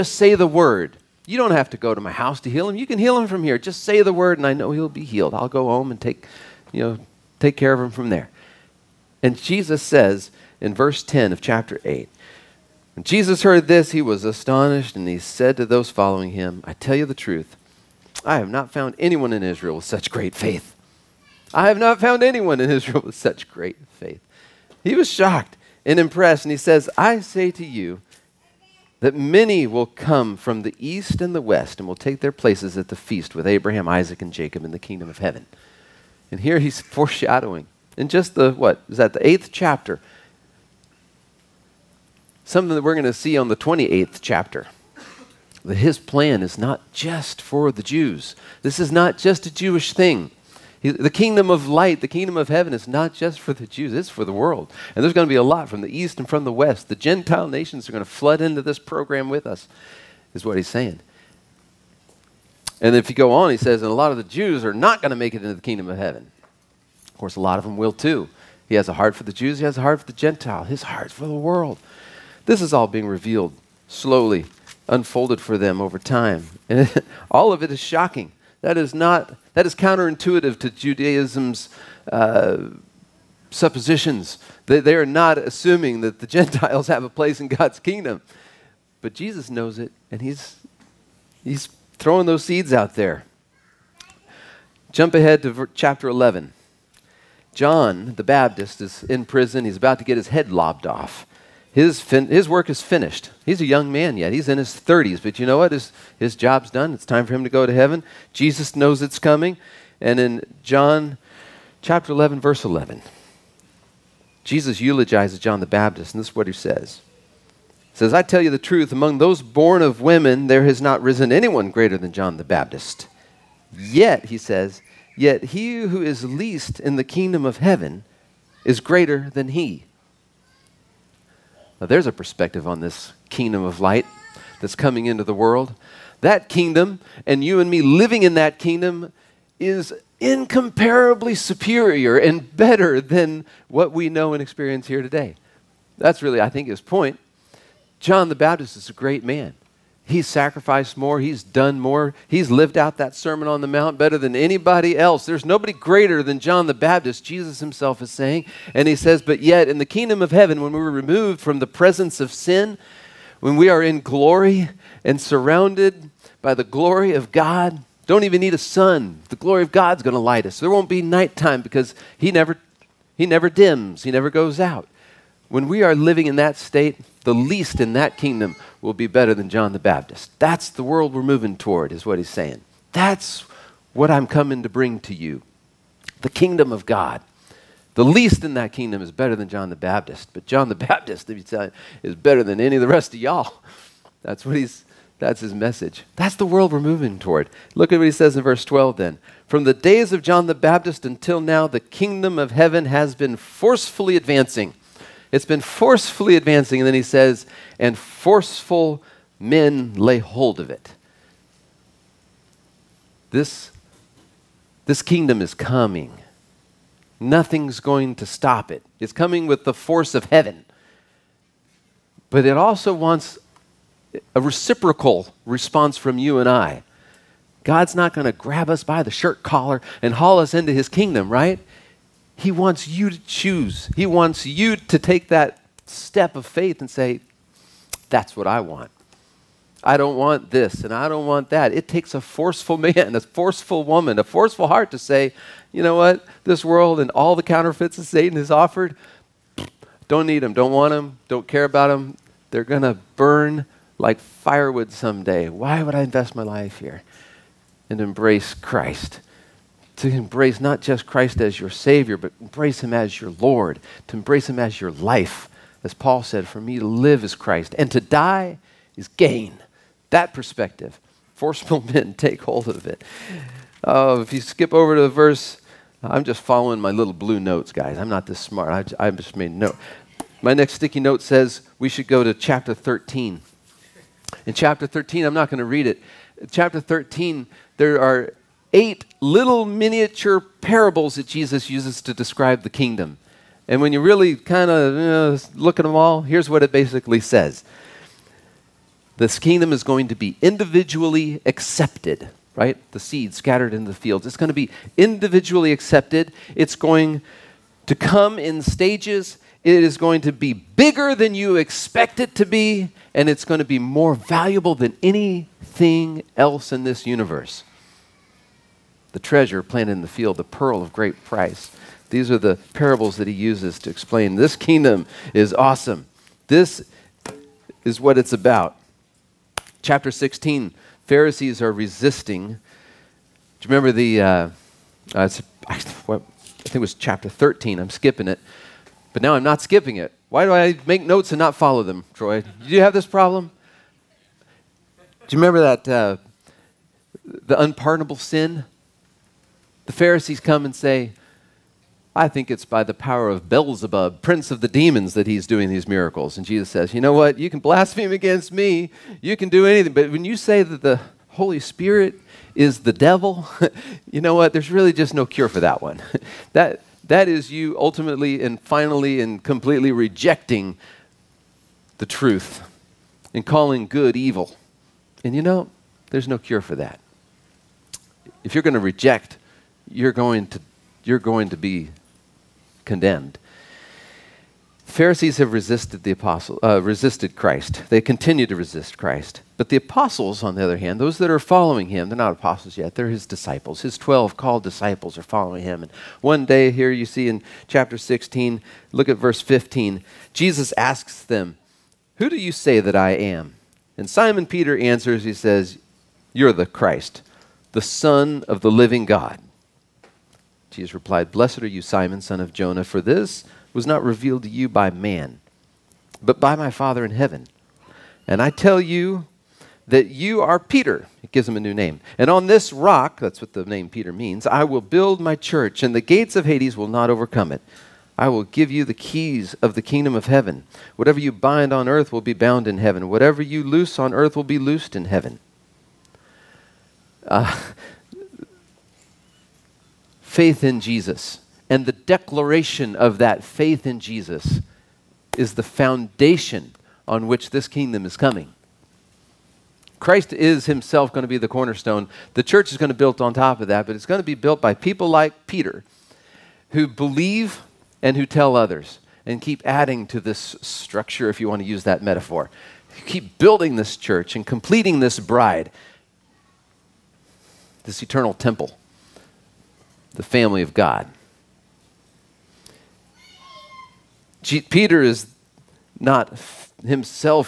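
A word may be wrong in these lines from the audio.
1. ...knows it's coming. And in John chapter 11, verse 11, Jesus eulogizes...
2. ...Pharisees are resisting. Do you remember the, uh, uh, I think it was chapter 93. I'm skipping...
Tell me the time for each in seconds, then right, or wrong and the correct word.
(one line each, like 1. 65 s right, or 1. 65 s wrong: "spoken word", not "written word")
1. 108 s right
2. 331 s wrong: "13", not "93".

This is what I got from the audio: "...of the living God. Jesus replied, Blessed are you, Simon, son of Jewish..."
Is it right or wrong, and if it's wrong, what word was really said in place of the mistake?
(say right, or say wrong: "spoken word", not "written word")
wrong: "Jonah", not "Jewish".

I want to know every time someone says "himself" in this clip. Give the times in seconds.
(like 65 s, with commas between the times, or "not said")
157 s, 450 s, 476 s.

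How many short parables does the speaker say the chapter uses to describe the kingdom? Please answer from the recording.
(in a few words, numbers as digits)
Eight.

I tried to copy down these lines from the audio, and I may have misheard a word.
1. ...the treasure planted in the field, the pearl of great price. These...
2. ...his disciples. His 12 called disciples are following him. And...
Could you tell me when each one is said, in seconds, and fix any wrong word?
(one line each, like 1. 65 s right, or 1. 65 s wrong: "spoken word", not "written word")
1. 319 s right
2. 393 s right.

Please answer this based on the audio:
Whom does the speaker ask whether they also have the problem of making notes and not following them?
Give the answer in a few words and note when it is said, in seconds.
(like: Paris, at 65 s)
Troy, at 342 s.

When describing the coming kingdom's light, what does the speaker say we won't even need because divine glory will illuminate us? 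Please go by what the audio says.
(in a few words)
A sun.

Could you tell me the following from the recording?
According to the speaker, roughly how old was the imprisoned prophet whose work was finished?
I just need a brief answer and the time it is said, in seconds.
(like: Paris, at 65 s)
In his 30s, at 104 s.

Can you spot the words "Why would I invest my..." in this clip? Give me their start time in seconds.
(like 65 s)
255 s.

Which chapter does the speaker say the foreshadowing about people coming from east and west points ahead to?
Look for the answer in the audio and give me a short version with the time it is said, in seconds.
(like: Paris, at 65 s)
28th chapter, at 43 s.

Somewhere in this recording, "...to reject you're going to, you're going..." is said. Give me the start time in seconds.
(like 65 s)
378 s.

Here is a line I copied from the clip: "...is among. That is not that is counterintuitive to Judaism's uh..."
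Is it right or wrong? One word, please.
wrong.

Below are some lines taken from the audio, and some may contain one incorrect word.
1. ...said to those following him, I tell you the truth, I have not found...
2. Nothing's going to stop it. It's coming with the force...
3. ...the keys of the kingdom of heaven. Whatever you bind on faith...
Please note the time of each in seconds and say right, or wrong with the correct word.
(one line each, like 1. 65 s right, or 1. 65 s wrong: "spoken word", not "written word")
1. 15 s right
2. 217 s right
3. 428 s wrong: "earth", not "faith".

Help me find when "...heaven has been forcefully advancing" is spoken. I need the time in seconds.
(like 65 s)
202 s.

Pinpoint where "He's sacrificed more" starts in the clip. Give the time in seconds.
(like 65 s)
150 s.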